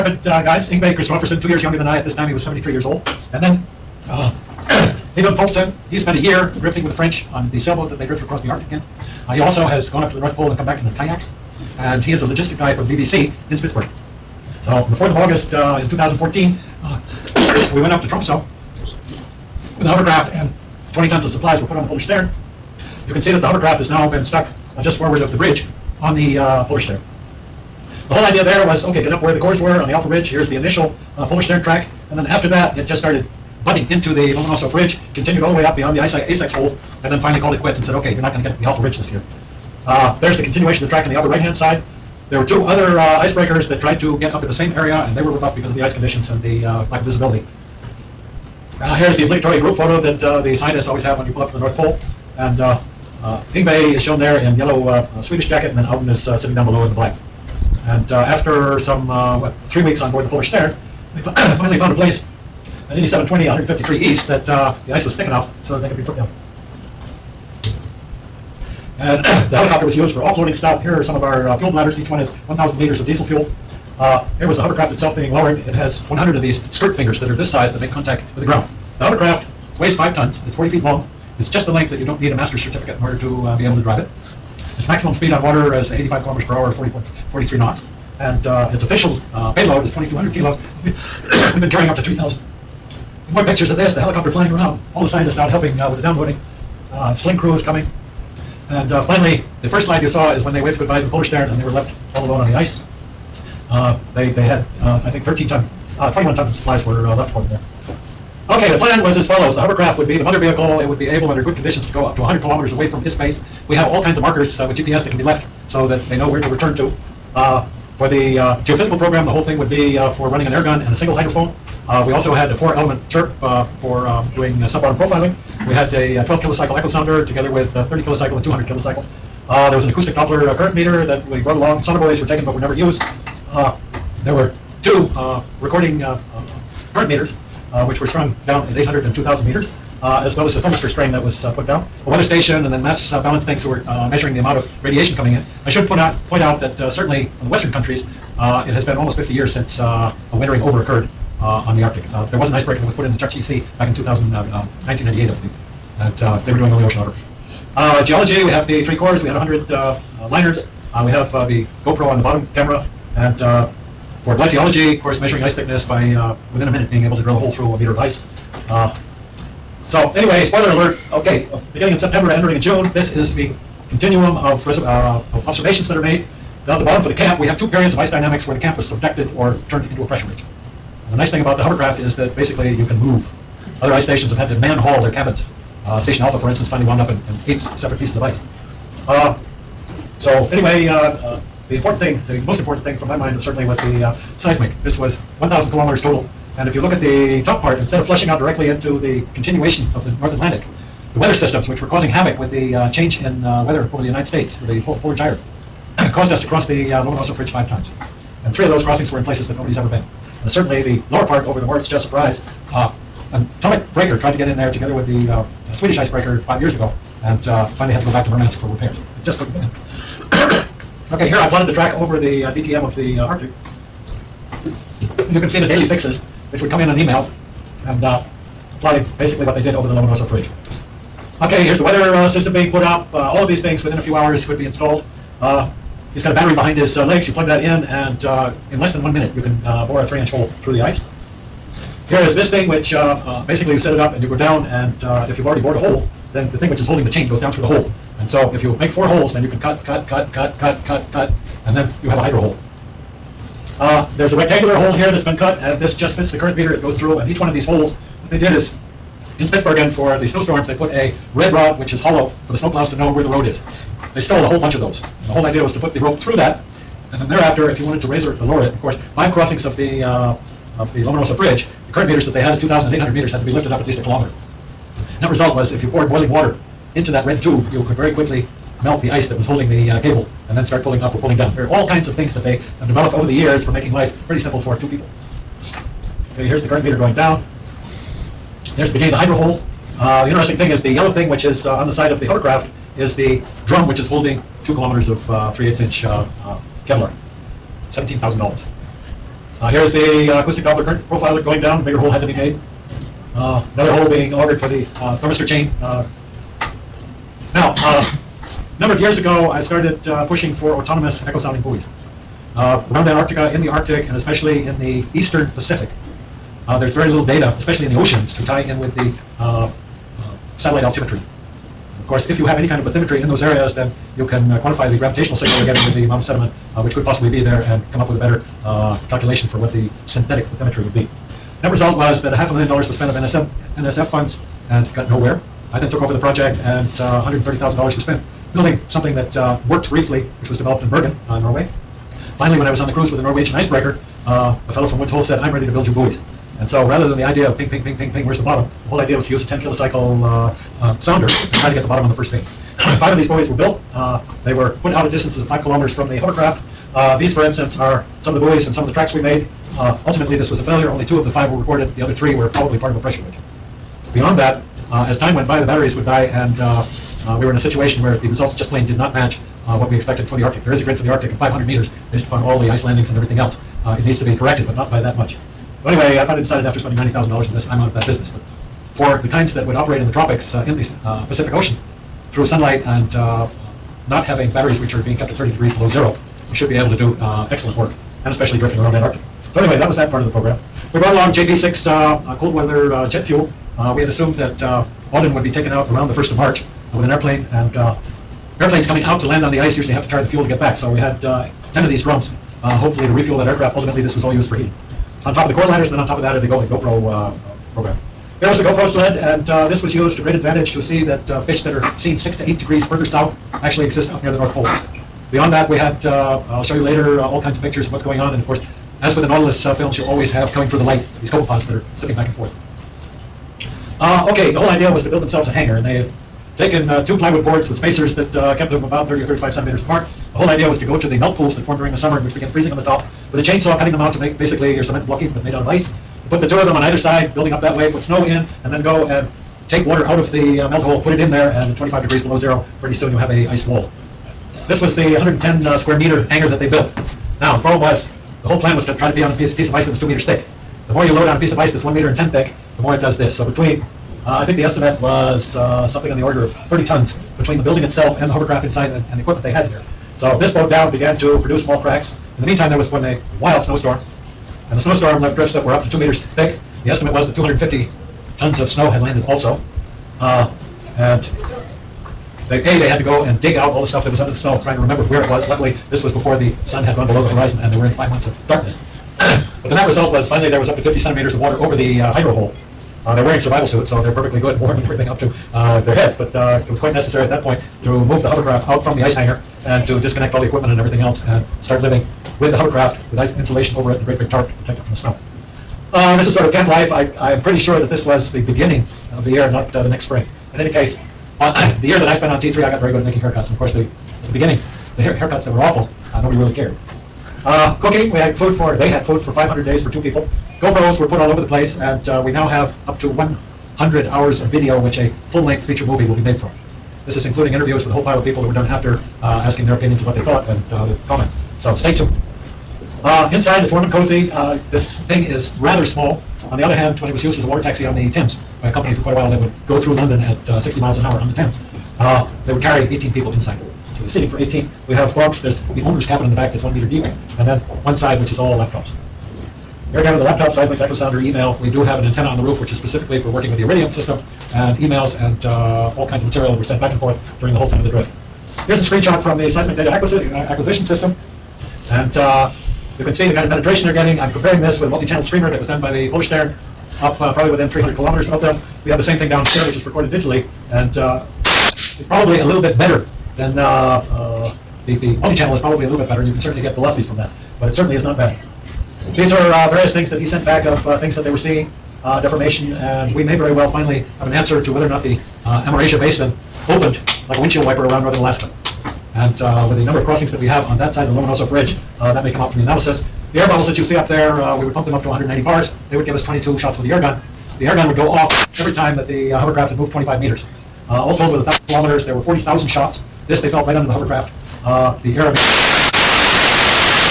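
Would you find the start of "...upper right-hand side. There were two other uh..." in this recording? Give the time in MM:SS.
00:41.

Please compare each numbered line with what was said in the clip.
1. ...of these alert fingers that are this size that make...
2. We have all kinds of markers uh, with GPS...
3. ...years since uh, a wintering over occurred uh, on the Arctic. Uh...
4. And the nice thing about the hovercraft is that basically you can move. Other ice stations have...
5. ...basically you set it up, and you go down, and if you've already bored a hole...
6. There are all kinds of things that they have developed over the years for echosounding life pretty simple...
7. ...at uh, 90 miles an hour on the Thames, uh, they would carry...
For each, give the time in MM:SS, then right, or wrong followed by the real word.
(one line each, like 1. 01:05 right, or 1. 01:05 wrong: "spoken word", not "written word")
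1. 01:16 wrong: "skirt", not "alert"
2. 01:53 right
3. 02:29 right
4. 03:01 right
5. 04:03 right
6. 04:41 wrong: "making", not "echosounding"
7. 08:50 wrong: "60", not "90".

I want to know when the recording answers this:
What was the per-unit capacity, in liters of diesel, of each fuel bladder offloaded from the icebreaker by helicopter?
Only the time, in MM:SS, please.
01:12.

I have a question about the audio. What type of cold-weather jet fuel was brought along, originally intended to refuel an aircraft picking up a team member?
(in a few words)
JP6.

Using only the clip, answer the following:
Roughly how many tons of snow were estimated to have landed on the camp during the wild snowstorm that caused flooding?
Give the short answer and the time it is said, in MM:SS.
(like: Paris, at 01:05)
250 tons, at 07:47.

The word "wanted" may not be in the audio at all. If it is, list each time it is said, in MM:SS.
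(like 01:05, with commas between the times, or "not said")
04:27.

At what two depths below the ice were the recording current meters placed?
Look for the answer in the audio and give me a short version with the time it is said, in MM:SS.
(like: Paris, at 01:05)
800 and 2,000 meters, at 02:18.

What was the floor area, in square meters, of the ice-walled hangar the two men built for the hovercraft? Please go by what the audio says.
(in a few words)
110 square meters.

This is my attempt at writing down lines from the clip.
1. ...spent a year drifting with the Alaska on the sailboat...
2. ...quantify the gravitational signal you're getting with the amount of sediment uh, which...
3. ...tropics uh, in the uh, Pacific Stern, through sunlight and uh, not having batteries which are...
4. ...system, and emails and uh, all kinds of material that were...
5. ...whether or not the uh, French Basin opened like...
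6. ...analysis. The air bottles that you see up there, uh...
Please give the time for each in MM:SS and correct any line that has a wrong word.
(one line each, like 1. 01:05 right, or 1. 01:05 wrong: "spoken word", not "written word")
1. 00:05 wrong: "French", not "Alaska"
2. 05:24 right
3. 06:20 wrong: "Ocean", not "Stern"
4. 09:03 right
5. 09:34 wrong: "Amerasia", not "French"
6. 09:42 right.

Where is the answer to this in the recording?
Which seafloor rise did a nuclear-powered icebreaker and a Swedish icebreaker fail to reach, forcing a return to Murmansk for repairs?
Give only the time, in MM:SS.
03:31.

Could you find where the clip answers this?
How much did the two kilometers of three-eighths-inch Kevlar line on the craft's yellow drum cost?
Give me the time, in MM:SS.
04:57.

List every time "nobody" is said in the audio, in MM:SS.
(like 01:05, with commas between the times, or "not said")
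03:29, 08:26.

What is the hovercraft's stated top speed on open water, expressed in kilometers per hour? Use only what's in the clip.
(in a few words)
85 km/h.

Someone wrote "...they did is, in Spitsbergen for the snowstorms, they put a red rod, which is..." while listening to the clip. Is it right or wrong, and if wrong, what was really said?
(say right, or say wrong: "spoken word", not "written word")
right.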